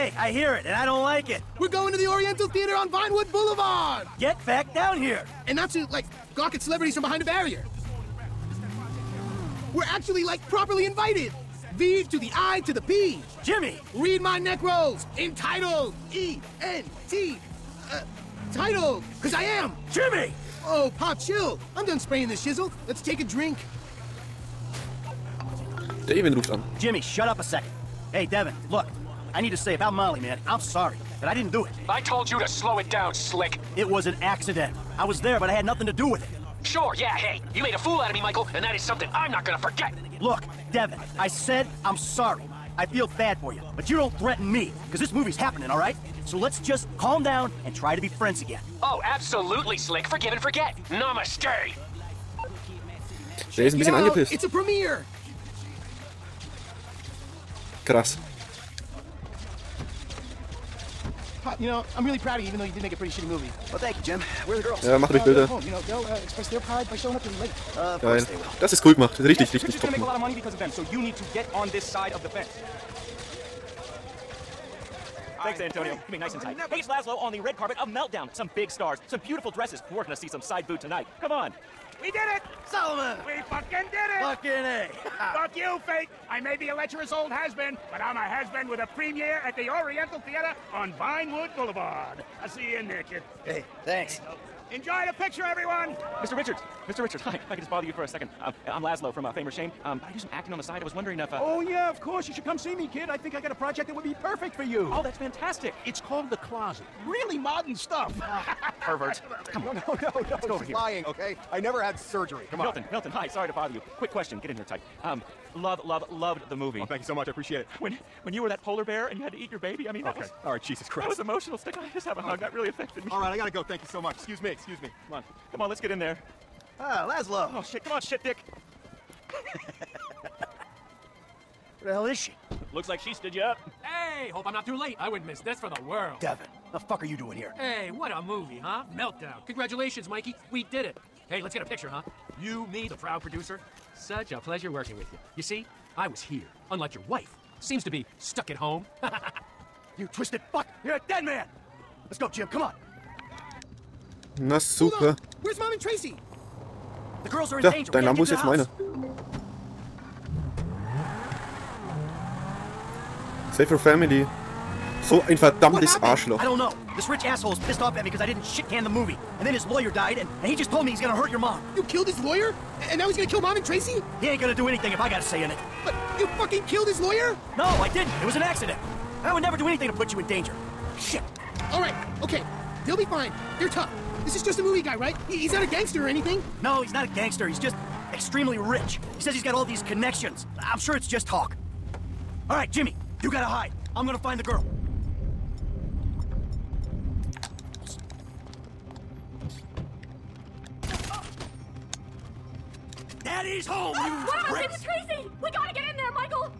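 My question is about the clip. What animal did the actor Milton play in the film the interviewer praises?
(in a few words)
polar bear.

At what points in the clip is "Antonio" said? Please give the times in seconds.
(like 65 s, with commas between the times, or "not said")
75 s.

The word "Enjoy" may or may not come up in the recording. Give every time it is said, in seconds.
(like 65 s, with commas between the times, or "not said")
94 s.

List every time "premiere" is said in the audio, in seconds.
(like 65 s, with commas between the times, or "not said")
88 s.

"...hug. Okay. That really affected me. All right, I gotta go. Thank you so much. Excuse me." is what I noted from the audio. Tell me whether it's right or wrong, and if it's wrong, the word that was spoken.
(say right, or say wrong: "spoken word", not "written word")
right.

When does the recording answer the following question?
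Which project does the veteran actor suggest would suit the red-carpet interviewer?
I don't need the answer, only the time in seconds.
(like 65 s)
106 s.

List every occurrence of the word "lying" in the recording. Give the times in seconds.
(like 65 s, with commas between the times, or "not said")
110 s.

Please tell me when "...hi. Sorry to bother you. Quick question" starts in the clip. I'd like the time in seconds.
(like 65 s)
113 s.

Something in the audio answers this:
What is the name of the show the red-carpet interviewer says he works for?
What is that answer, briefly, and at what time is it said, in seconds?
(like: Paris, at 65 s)
Fame or Shame, at 99 s.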